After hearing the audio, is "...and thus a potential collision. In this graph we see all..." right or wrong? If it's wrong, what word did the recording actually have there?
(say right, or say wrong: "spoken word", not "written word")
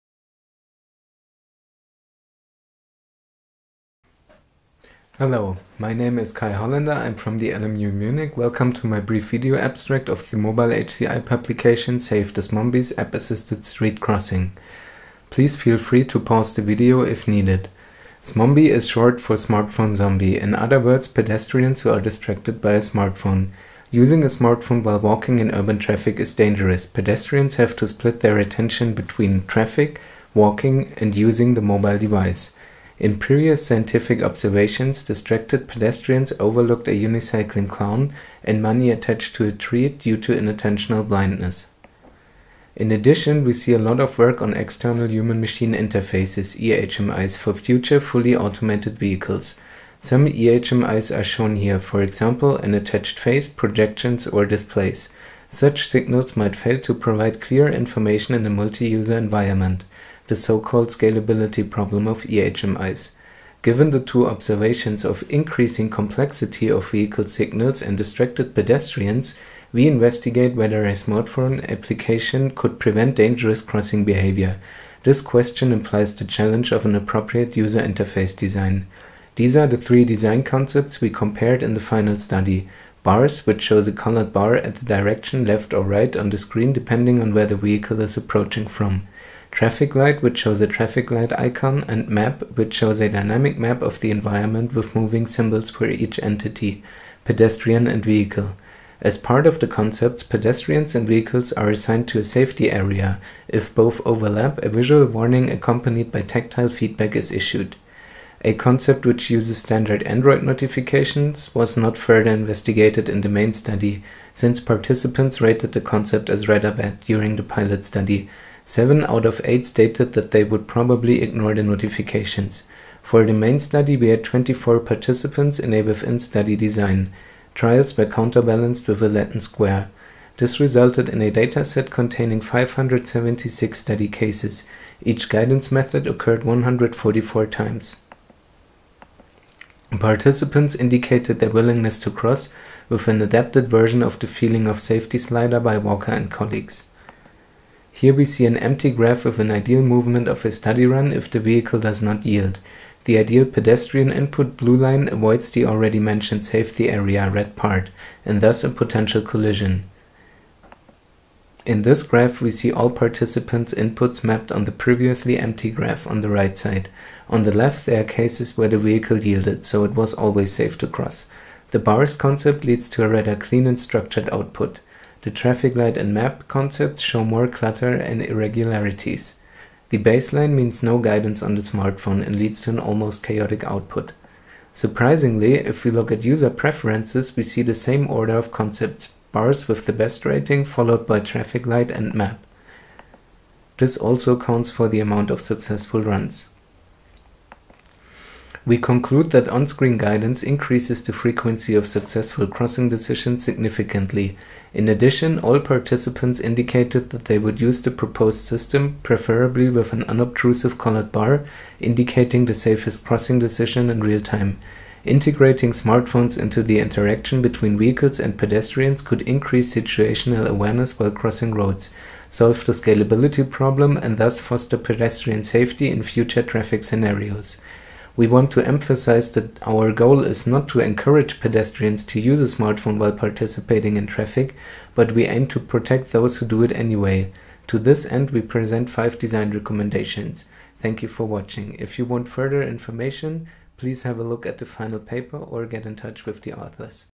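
right.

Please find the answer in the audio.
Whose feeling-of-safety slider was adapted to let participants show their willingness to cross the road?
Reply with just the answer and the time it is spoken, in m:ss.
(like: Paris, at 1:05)
Walker and colleagues, at 2:25.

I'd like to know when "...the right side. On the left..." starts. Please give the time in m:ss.
2:46.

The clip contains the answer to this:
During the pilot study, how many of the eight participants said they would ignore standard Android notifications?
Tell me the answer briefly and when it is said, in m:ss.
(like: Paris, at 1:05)
7, at 1:58.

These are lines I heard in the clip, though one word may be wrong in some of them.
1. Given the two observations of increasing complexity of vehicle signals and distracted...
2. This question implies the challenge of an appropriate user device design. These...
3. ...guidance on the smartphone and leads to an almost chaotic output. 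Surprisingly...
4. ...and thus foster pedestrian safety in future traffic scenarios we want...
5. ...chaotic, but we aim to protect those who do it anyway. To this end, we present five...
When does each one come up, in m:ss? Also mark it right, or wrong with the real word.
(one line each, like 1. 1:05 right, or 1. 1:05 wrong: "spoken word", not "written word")
1. 1:03 right
2. 1:15 wrong: "interface", not "device"
3. 3:00 right
4. 3:43 right
5. 3:54 wrong: "traffic", not "chaotic".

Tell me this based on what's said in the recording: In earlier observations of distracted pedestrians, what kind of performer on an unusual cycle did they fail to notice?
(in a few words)
unicycling clown.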